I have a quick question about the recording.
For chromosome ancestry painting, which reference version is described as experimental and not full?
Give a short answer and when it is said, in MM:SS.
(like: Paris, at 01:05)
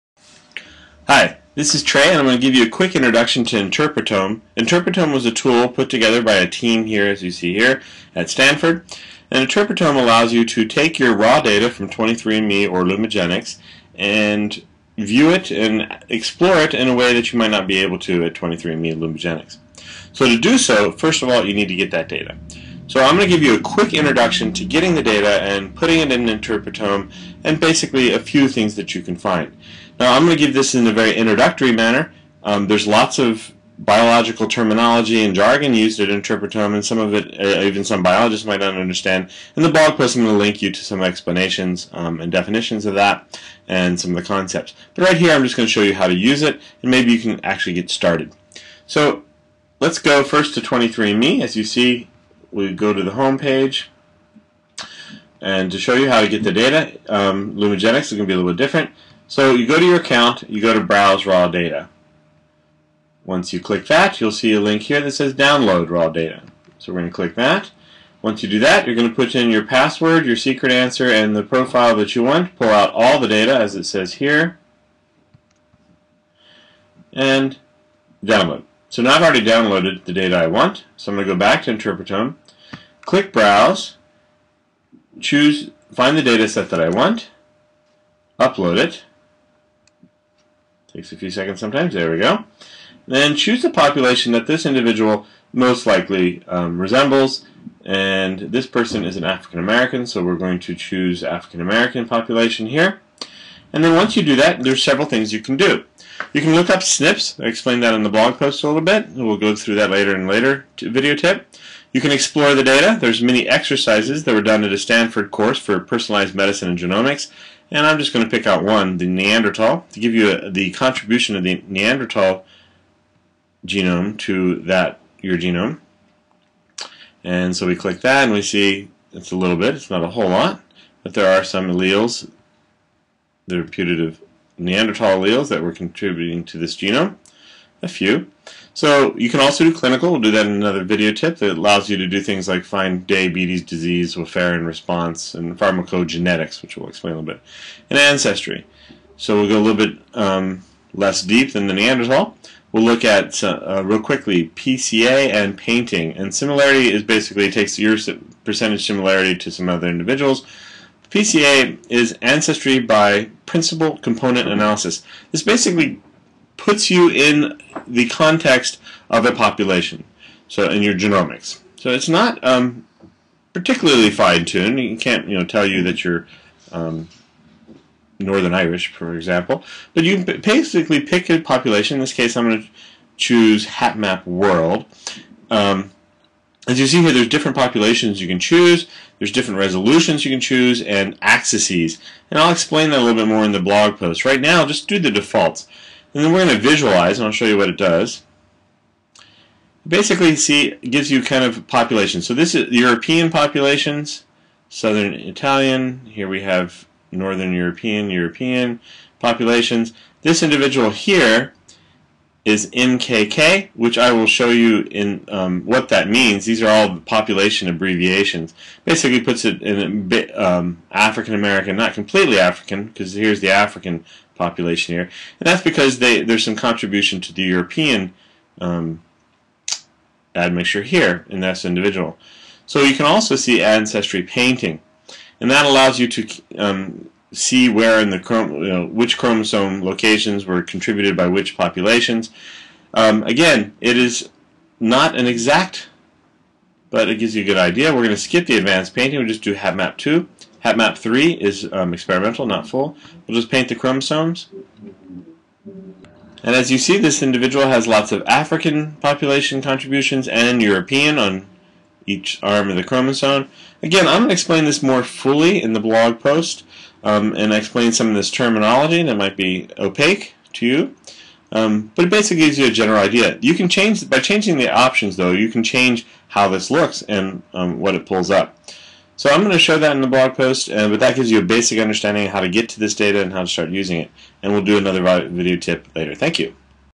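HapMap 3, at 04:10.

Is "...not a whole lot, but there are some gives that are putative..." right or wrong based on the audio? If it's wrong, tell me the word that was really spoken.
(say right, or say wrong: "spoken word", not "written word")
wrong: "alleles", not "gives".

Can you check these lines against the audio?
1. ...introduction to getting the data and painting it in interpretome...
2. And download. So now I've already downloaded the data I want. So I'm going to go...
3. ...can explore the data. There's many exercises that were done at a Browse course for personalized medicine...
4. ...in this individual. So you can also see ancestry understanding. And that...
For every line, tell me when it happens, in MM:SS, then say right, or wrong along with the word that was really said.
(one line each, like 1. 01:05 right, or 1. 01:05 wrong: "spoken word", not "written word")
1. 00:23 wrong: "putting", not "painting"
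2. 01:17 right
3. 01:52 wrong: "Stanford", not "Browse"
4. 03:51 wrong: "painting", not "understanding".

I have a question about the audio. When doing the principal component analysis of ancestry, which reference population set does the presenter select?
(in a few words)
HapMap World.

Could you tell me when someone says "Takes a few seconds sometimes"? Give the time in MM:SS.
01:30.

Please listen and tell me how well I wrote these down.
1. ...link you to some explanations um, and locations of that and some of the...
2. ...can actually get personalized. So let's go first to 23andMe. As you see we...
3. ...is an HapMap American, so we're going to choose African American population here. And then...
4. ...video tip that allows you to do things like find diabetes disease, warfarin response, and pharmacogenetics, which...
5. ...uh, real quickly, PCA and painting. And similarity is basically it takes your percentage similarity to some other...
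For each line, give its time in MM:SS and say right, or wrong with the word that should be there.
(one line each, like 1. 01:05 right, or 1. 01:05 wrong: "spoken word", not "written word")
1. 00:40 wrong: "definitions", not "locations"
2. 00:47 wrong: "started", not "personalized"
3. 01:39 wrong: "African", not "HapMap"
4. 02:20 right
5. 02:33 right.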